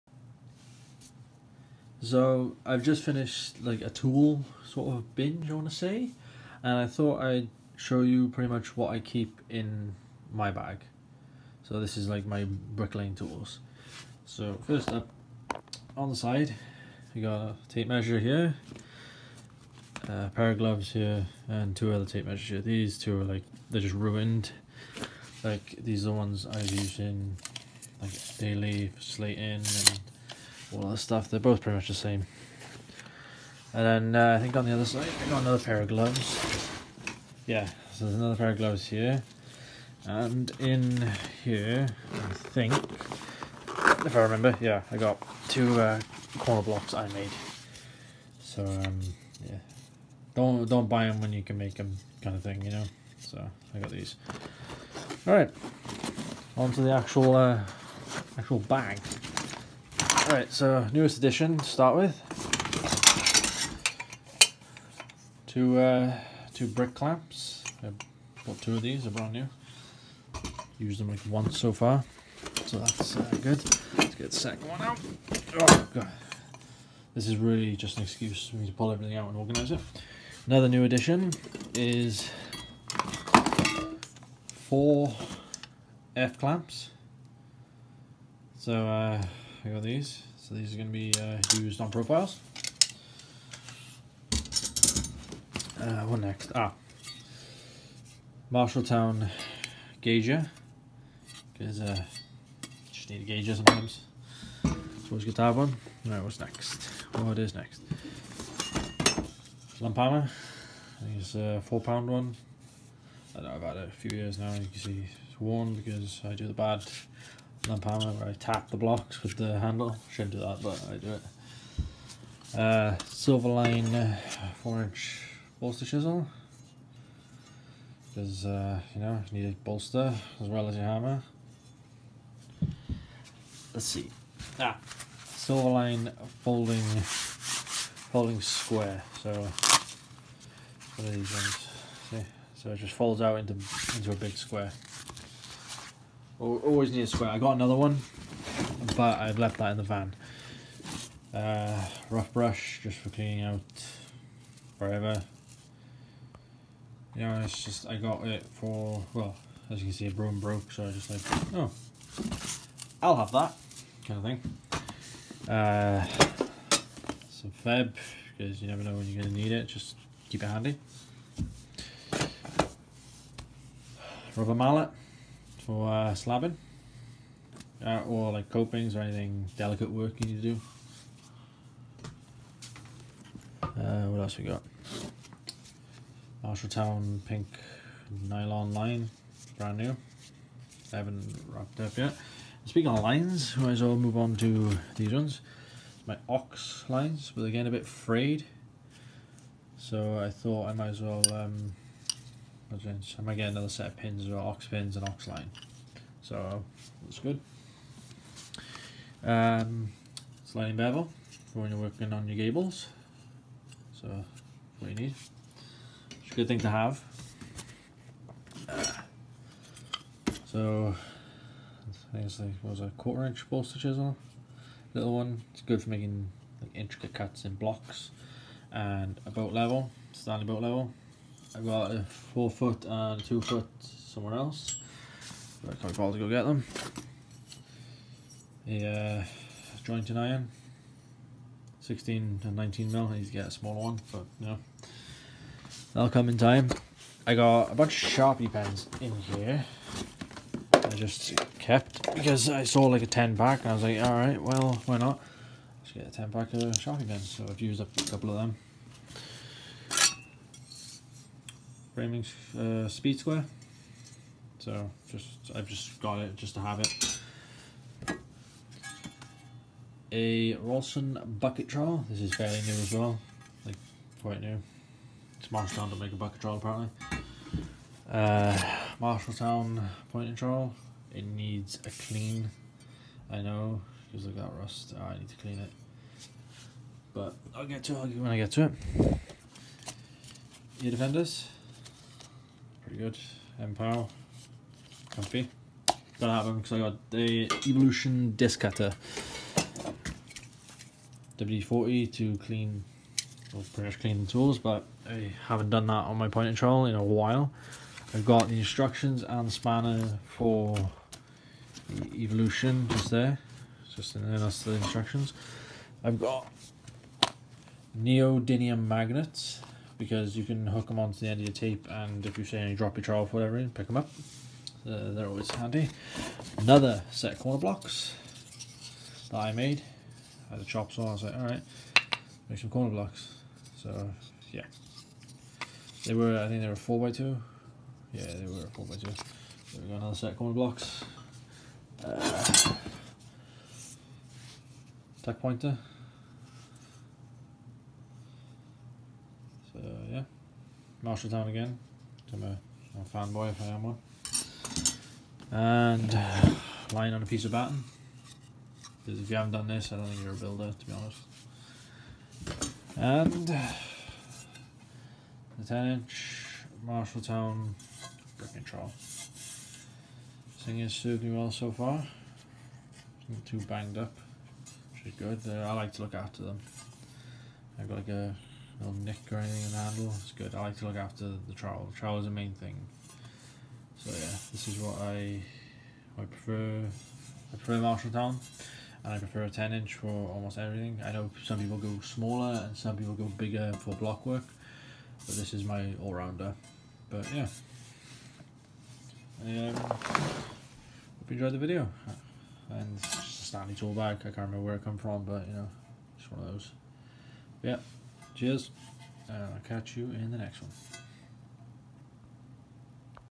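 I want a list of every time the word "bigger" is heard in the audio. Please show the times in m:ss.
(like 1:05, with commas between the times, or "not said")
6:33.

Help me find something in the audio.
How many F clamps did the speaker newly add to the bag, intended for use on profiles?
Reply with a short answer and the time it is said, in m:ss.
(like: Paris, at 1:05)
4, at 1:24.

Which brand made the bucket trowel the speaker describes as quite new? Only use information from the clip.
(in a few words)
Rolson.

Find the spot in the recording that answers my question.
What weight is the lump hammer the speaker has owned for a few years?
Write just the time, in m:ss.
1:51.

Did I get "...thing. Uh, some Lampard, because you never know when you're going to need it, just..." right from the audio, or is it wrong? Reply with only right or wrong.
wrong.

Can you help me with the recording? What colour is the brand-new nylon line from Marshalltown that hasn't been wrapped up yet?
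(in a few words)
Pink.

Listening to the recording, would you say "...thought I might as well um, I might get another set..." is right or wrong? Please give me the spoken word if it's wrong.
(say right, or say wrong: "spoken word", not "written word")
right.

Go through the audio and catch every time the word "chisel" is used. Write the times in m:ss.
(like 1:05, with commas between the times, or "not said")
2:05, 3:43.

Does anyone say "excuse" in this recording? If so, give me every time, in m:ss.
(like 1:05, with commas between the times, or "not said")
1:18.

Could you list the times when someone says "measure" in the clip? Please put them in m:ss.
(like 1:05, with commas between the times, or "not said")
0:17, 0:22.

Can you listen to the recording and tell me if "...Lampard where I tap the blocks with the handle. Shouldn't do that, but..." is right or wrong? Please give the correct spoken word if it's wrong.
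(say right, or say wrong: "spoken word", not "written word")
right.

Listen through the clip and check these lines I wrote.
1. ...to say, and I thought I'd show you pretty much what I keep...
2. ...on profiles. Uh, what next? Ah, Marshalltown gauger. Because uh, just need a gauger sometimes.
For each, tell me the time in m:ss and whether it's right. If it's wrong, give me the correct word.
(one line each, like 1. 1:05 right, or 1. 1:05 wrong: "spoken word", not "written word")
1. 0:05 right
2. 1:31 right.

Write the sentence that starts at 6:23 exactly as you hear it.
So yeah, this is what I I prefer.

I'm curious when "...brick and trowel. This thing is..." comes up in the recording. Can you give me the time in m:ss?
6:08.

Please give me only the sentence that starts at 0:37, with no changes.
Yeah, so there's another pair of gloves here.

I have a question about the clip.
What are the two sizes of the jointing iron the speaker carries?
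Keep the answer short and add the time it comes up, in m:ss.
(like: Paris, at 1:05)
16 and 19 mm, at 4:01.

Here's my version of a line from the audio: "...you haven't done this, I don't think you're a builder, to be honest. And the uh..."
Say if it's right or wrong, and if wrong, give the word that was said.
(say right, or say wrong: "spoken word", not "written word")
right.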